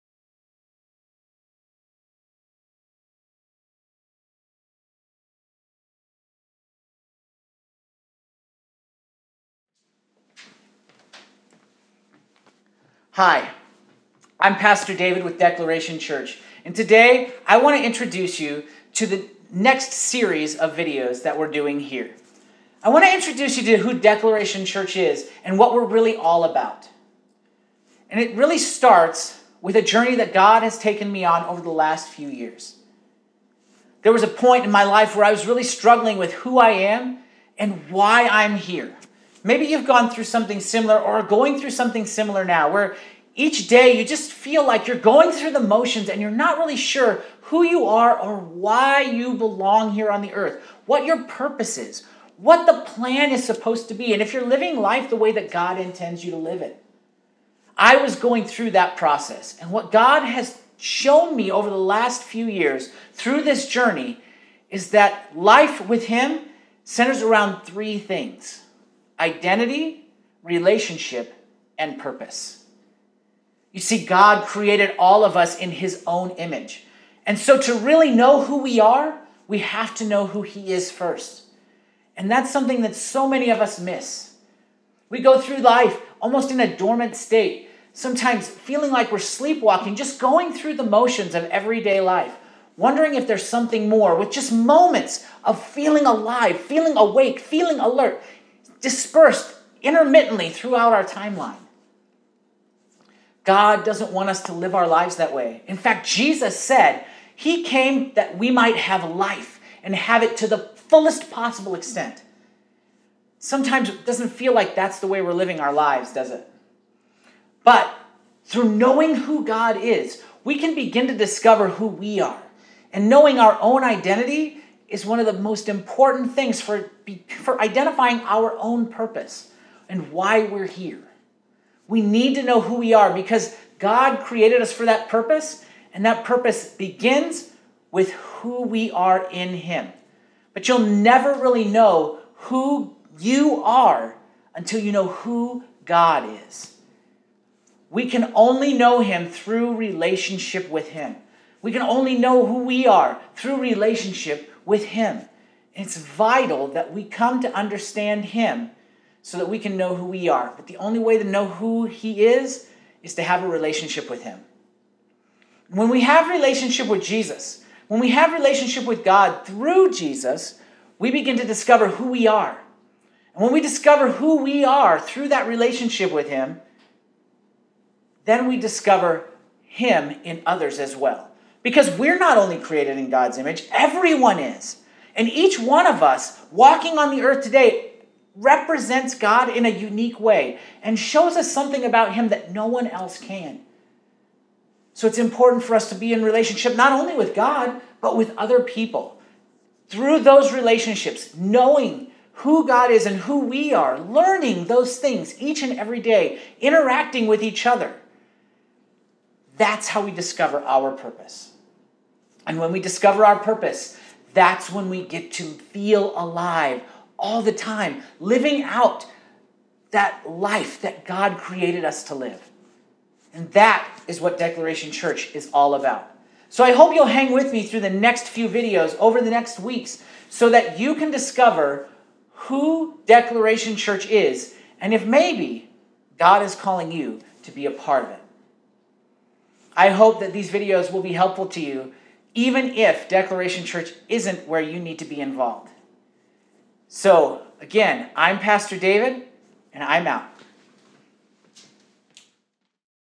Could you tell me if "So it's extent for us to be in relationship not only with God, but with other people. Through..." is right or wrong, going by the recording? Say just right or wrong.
wrong.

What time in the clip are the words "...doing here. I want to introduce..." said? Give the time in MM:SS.
00:21.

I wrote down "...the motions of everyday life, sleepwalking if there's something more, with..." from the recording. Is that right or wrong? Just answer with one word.
wrong.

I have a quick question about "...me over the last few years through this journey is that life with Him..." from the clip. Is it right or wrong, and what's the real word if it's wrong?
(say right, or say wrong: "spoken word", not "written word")
right.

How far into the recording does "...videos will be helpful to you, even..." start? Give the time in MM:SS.
04:00.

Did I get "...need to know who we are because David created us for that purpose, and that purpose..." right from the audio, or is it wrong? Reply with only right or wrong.
wrong.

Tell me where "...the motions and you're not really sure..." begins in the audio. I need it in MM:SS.
00:45.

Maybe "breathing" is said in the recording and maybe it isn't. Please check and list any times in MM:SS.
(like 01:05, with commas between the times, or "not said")
not said.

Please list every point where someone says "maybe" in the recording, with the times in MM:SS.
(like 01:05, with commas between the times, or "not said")
00:39, 03:55.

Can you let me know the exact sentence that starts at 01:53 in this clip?
Sometimes it doesn't feel like that's the way we're living our lives, does it?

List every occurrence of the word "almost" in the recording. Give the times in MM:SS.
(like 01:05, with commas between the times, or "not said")
01:26.